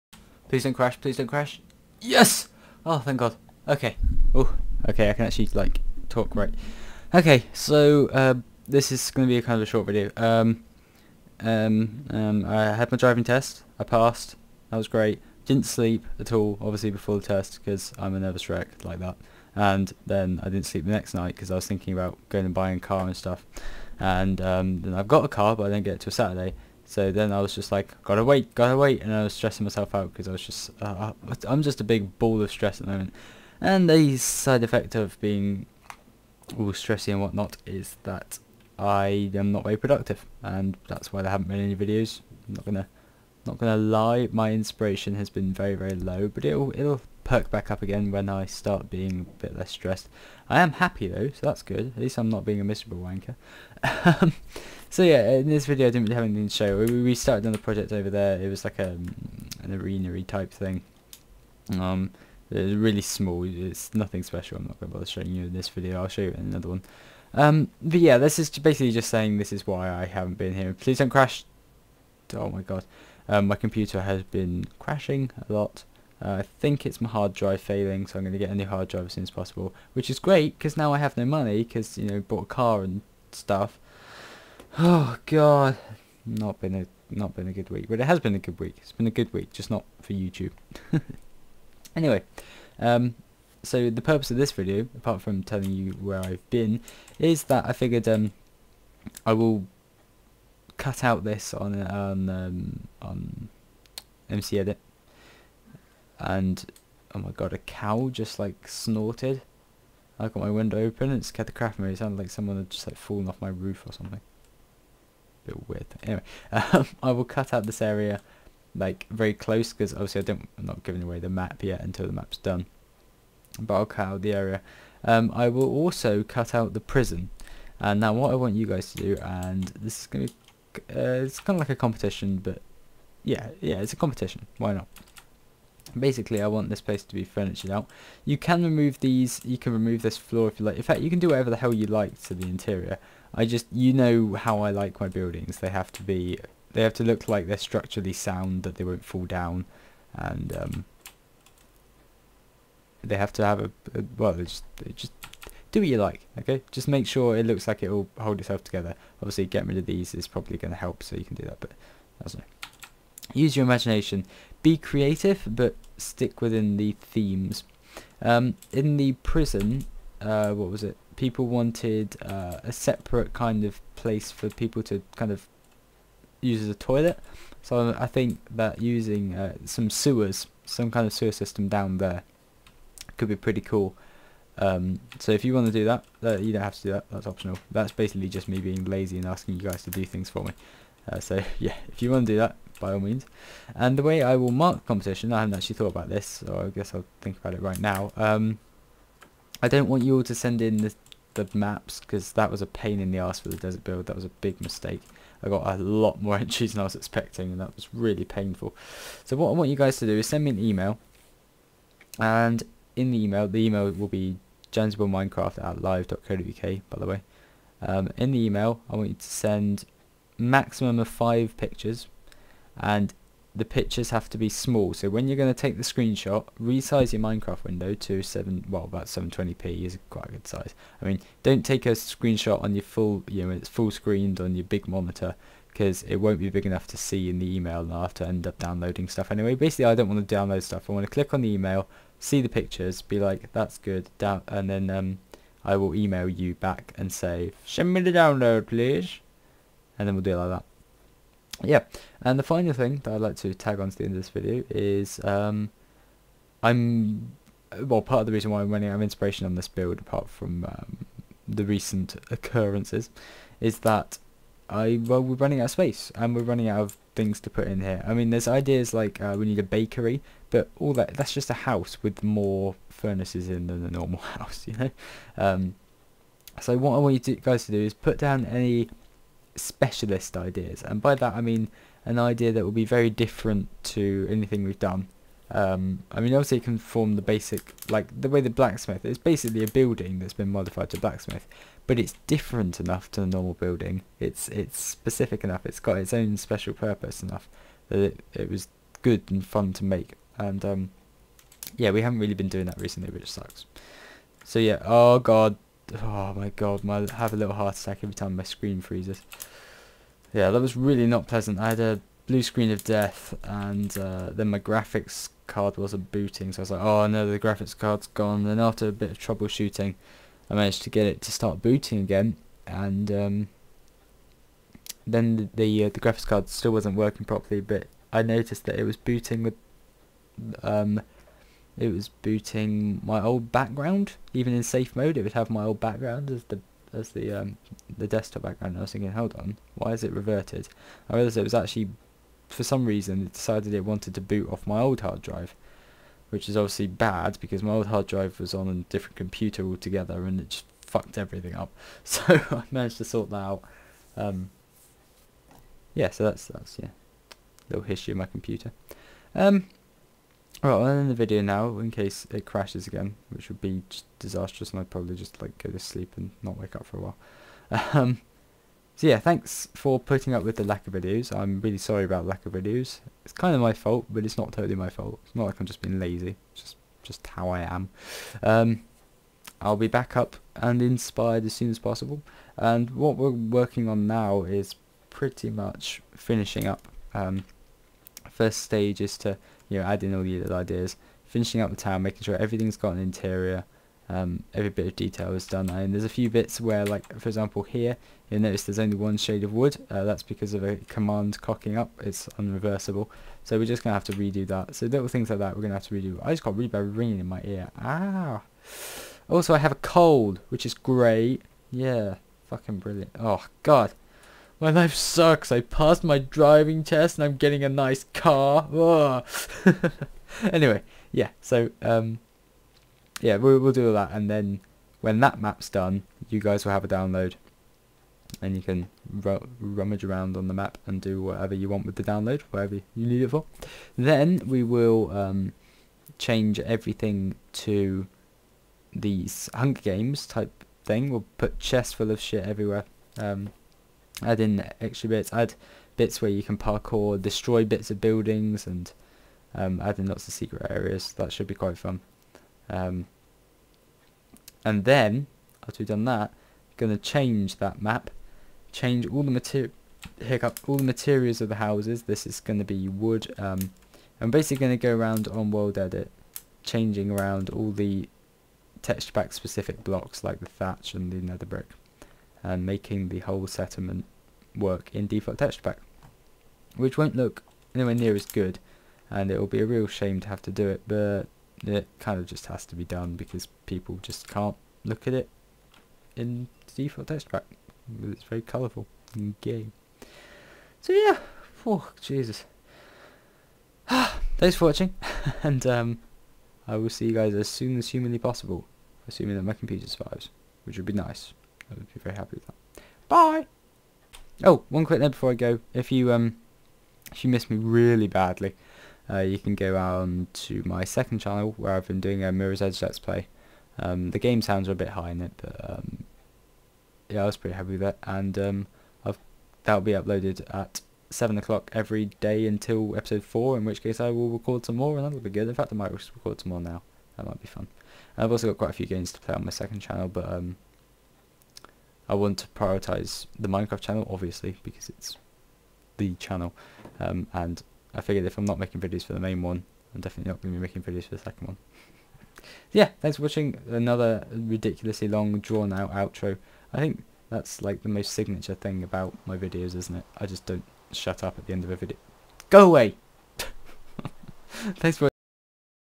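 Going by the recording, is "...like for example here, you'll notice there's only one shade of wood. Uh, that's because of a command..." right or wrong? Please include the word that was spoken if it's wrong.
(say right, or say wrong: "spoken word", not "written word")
right.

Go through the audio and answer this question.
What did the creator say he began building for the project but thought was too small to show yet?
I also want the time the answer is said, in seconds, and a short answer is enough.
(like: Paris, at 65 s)
arenery type thing, at 59 s.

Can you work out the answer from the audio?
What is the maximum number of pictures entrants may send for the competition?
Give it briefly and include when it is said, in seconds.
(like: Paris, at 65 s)
5, at 221 s.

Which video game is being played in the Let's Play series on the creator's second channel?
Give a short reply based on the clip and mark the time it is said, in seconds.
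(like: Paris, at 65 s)
Mirror's Edge, at 512 s.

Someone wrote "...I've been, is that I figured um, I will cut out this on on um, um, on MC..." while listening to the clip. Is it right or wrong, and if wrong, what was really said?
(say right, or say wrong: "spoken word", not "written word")
right.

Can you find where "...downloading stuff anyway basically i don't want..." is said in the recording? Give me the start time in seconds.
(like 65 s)
238 s.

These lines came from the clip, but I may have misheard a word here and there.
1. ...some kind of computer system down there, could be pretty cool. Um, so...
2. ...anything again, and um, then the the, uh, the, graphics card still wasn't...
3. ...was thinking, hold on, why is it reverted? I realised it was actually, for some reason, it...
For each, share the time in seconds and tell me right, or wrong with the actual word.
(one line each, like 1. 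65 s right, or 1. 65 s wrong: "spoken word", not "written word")
1. 180 s wrong: "sewer", not "computer"
2. 321 s wrong: "booting", not "anything"
3. 338 s right.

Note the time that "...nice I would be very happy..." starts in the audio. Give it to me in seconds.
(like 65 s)
500 s.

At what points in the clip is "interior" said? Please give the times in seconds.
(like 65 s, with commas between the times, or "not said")
142 s, 392 s.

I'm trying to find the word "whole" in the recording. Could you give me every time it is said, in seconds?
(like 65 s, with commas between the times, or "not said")
473 s.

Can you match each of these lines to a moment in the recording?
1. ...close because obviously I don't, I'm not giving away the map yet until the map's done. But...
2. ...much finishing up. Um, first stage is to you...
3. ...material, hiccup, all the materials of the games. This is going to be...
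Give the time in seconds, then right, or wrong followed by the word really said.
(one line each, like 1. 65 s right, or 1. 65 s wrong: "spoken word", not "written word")
1. 119 s right
2. 385 s right
3. 459 s wrong: "houses", not "games".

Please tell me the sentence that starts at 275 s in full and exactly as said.
Um, so what I want you to, guys to do is put down any specialist ideas.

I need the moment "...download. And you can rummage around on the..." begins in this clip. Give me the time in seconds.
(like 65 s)
426 s.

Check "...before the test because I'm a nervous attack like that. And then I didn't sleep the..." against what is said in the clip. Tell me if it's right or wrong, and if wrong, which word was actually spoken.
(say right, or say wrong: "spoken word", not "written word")
wrong: "wreck", not "attack".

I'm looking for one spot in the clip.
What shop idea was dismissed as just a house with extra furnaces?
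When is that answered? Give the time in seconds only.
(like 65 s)
269 s.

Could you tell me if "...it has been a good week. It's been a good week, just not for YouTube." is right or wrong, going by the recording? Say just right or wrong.
right.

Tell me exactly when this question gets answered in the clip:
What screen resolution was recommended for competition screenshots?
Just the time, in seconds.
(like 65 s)
229 s.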